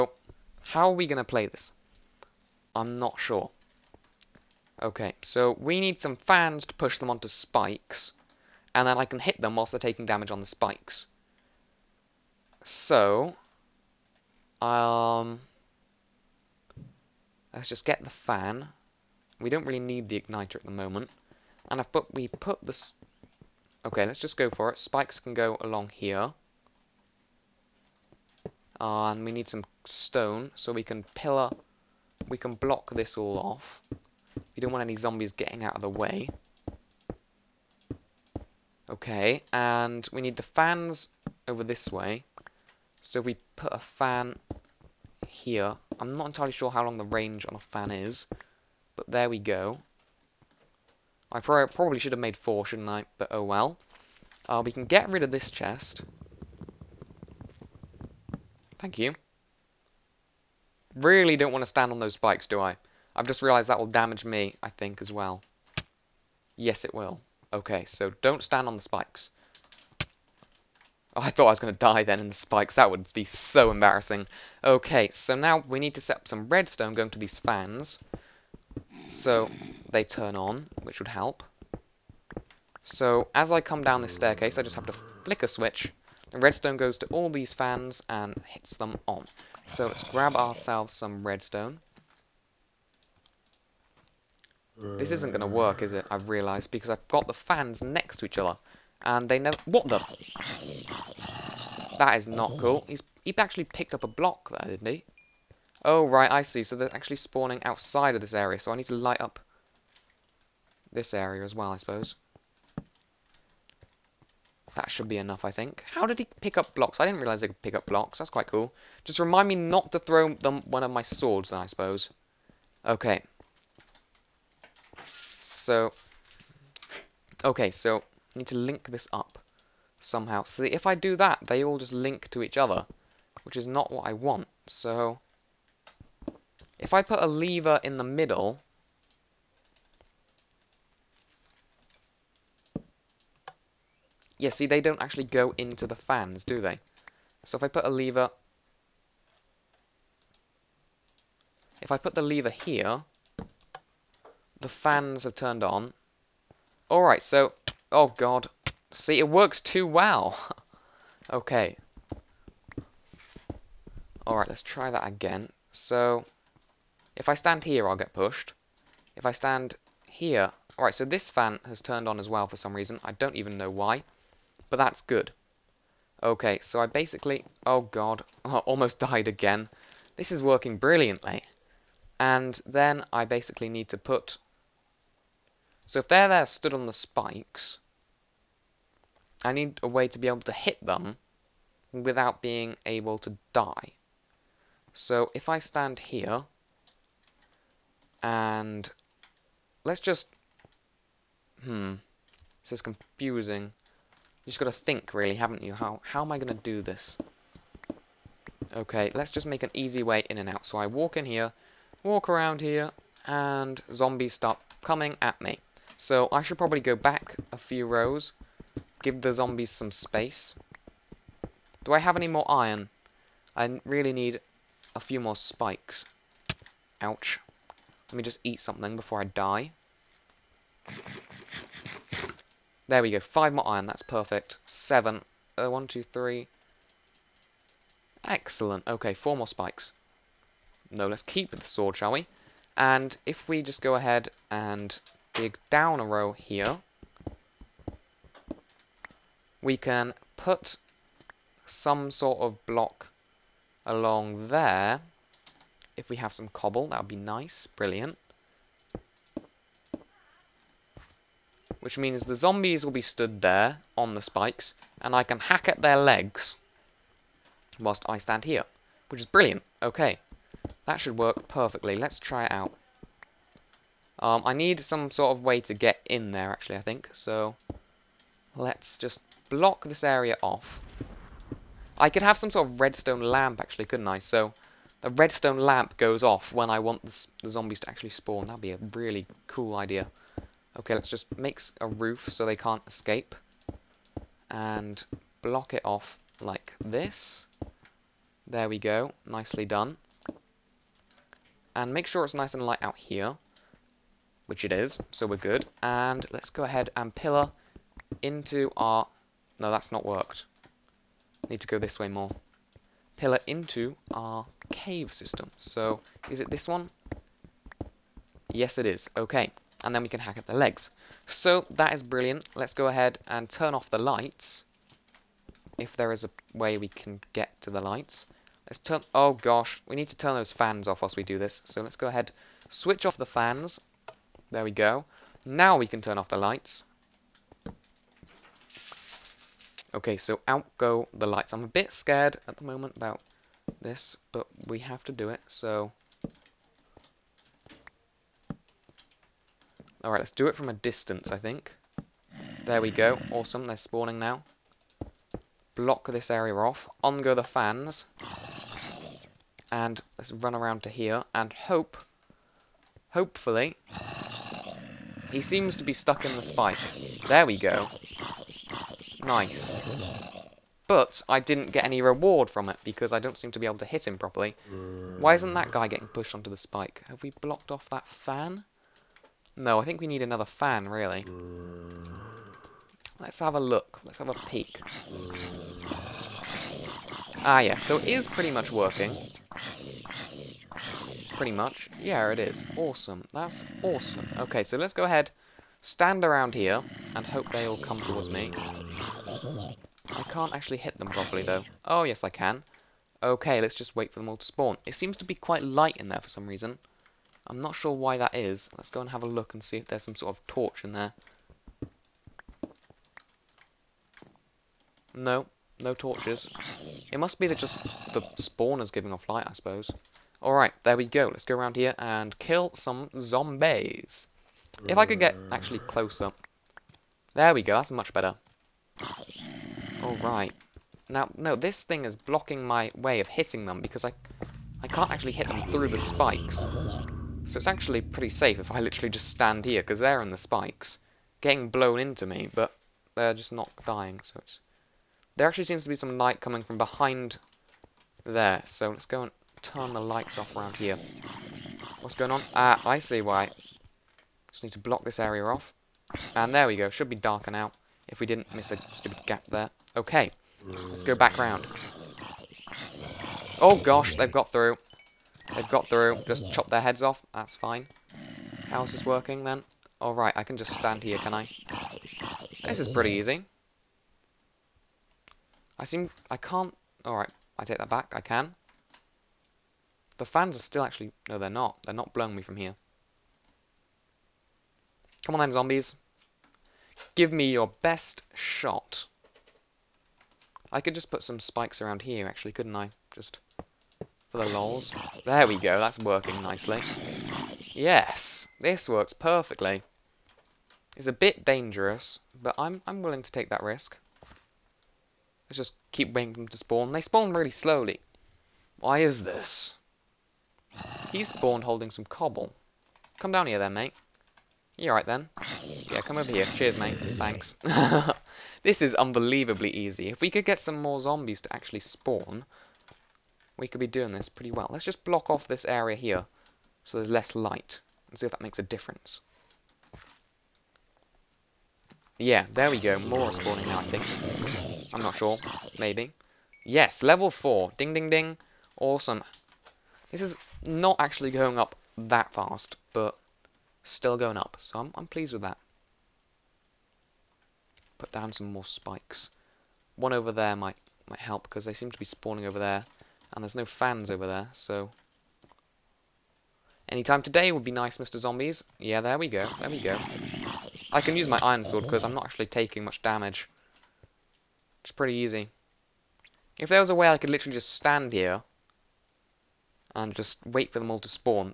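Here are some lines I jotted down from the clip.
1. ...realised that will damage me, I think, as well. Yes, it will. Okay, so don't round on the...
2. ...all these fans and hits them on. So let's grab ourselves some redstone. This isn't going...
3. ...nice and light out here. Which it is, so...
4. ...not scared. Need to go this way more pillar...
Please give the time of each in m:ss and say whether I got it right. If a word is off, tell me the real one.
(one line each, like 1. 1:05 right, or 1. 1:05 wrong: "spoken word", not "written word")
1. 1:03 wrong: "stand", not "round"
2. 1:27 right
3. 5:02 right
4. 5:09 wrong: "worked", not "scared".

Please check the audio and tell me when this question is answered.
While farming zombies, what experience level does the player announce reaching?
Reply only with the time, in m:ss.
8:57.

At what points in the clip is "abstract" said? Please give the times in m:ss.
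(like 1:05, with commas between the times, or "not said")
not said.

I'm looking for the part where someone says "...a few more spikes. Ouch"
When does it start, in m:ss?
3:44.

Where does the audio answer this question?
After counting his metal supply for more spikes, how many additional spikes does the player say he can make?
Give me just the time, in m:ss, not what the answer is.
3:59.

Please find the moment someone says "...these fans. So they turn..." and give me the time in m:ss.
1:17.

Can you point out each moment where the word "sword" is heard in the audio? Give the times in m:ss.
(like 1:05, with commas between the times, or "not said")
2:01, 4:01, 9:21.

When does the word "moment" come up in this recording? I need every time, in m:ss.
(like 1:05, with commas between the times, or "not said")
0:20, 5:42.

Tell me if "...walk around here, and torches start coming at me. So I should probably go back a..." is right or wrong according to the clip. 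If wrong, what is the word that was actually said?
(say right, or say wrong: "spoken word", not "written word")
wrong: "zombies", not "torches".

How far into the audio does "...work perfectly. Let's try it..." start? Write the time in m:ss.
4:31.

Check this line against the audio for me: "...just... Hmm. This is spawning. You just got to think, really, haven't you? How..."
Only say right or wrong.
wrong.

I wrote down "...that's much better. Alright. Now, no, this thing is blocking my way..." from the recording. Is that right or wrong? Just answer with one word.
right.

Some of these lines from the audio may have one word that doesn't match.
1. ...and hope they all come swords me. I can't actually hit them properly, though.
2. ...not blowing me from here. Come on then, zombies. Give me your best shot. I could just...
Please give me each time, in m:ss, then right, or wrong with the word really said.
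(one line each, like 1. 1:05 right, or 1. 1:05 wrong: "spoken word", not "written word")
1. 6:37 wrong: "towards", not "swords"
2. 8:01 right.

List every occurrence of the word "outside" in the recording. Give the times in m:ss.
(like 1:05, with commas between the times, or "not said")
1:47.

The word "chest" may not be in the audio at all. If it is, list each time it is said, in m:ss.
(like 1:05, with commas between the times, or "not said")
0:55.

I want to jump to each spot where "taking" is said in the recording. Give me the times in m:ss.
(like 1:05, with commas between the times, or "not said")
0:09, 9:22.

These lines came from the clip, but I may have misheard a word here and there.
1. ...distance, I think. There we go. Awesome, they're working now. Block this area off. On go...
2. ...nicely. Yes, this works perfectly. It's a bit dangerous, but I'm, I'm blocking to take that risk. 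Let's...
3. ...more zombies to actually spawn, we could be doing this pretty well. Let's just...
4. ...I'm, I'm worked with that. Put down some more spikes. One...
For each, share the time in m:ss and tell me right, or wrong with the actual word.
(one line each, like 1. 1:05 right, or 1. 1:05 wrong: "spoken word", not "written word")
1. 5:50 wrong: "spawning", not "working"
2. 8:16 wrong: "willing", not "blocking"
3. 8:40 right
4. 9:04 wrong: "pleased", not "worked".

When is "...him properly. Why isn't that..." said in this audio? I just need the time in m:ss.
6:14.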